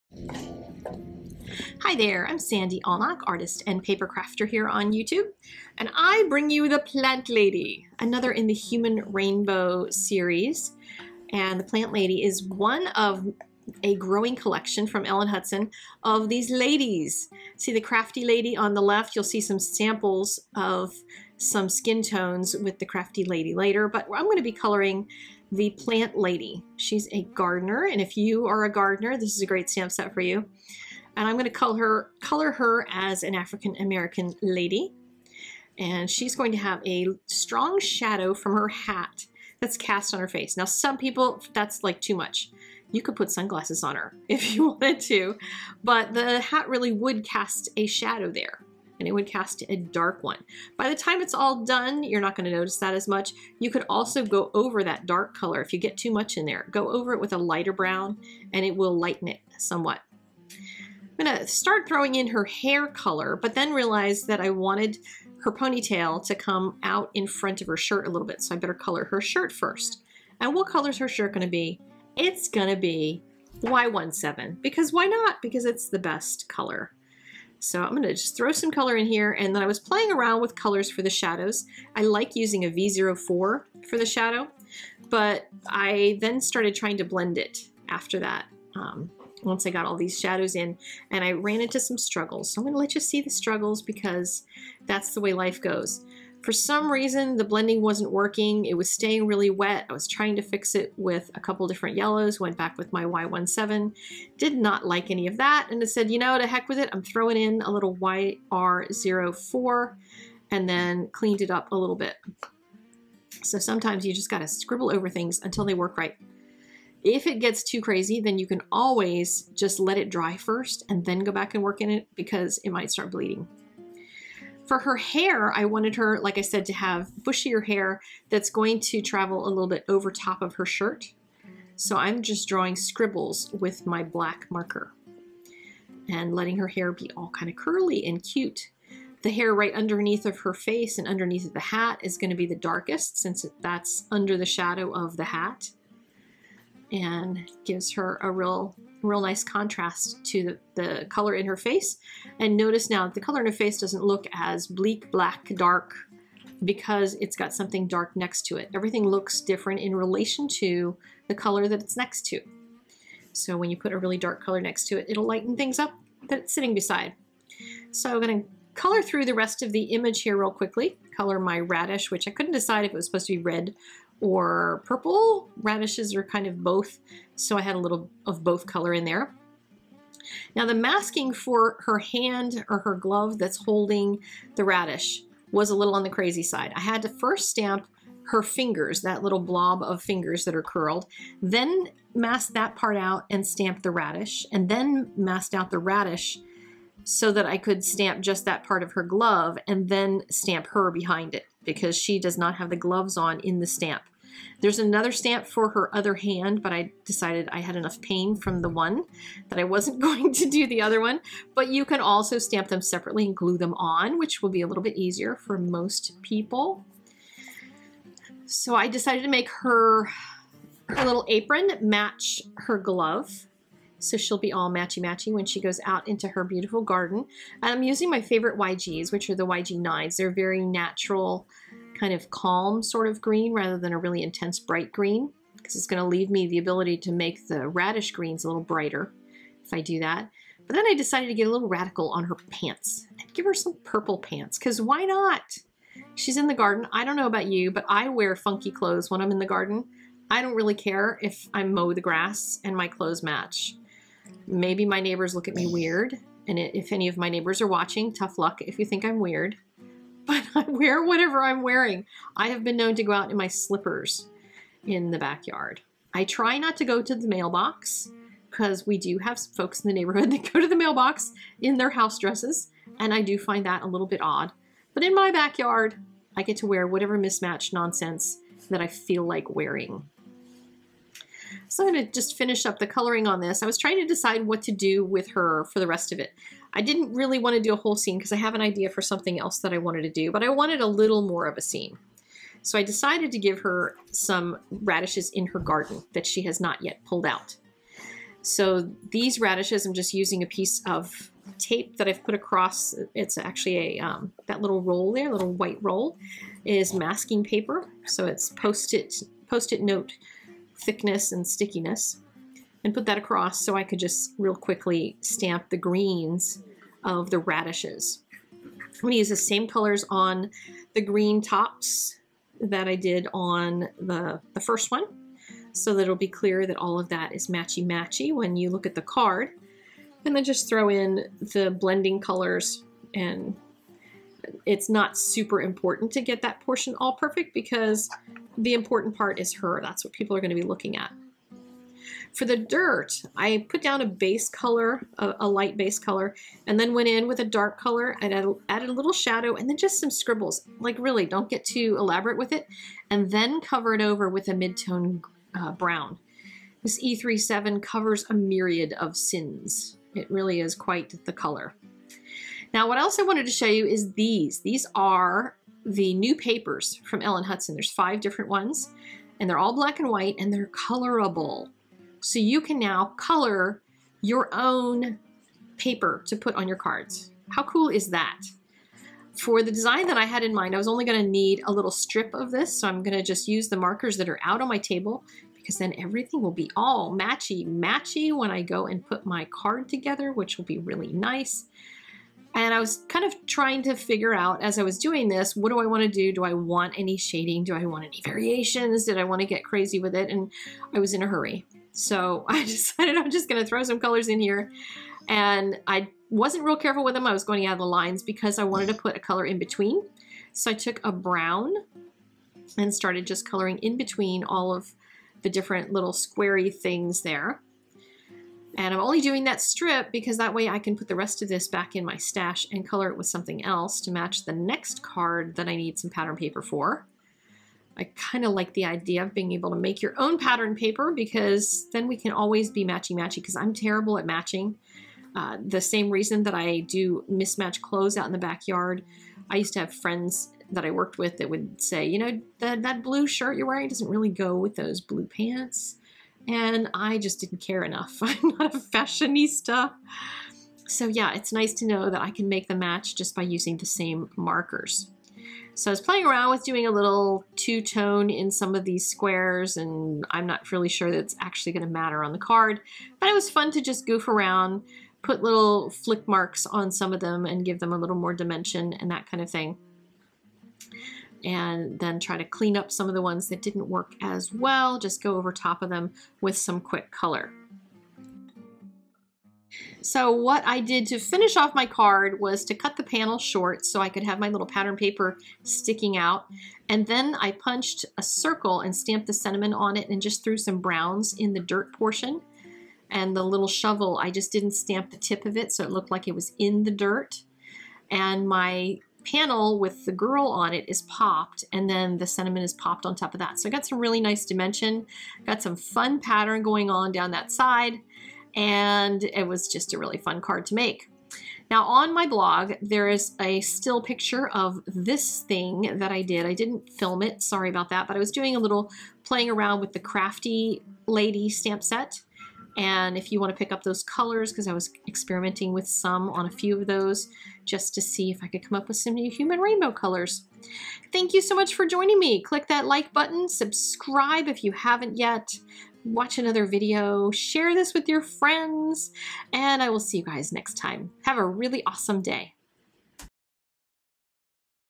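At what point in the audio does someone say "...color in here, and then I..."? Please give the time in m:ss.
1:18.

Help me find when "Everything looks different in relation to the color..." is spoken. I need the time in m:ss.
2:38.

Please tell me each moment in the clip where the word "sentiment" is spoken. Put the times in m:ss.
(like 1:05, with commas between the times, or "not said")
8:09, 8:22.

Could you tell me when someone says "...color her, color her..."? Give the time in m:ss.
0:31.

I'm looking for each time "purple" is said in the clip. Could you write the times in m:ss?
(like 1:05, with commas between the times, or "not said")
2:54, 4:03.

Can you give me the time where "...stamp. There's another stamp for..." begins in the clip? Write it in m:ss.
3:23.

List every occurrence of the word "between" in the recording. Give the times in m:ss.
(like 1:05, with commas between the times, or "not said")
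6:49, 6:53.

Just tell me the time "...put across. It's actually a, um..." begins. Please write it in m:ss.
5:02.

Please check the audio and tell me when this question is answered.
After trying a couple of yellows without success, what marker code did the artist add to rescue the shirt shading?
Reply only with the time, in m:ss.
1:47.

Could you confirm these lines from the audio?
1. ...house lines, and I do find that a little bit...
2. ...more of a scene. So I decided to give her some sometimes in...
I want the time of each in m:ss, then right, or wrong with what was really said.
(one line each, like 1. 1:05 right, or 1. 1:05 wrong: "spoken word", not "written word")
1. 4:31 wrong: "dresses", not "lines"
2. 4:51 wrong: "radishes", not "sometimes".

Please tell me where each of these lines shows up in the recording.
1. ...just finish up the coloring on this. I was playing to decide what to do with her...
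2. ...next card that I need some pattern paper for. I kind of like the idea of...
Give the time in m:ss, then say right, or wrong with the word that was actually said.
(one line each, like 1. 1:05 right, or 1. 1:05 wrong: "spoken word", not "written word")
1. 4:42 wrong: "trying", not "playing"
2. 7:04 right.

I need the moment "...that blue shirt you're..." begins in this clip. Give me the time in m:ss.
7:22.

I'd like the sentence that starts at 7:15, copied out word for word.
Uh, the same reason that I do mismatch clothes out in the backyard.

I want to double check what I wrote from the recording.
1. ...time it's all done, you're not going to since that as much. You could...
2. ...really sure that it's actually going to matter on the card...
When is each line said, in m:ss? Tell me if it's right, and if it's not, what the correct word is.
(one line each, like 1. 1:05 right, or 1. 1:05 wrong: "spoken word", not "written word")
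1. 0:50 wrong: "notice", not "since"
2. 7:40 right.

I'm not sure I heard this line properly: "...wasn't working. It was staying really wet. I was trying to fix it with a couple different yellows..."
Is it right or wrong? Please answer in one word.
right.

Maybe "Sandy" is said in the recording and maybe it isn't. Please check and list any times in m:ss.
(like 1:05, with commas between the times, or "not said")
0:02.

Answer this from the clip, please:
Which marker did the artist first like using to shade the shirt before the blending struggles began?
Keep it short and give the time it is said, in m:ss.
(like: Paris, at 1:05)
V04, at 1:22.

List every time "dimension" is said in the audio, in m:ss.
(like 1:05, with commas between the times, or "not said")
7:48, 8:24.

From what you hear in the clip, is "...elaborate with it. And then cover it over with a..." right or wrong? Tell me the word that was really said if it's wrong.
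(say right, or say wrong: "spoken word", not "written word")
right.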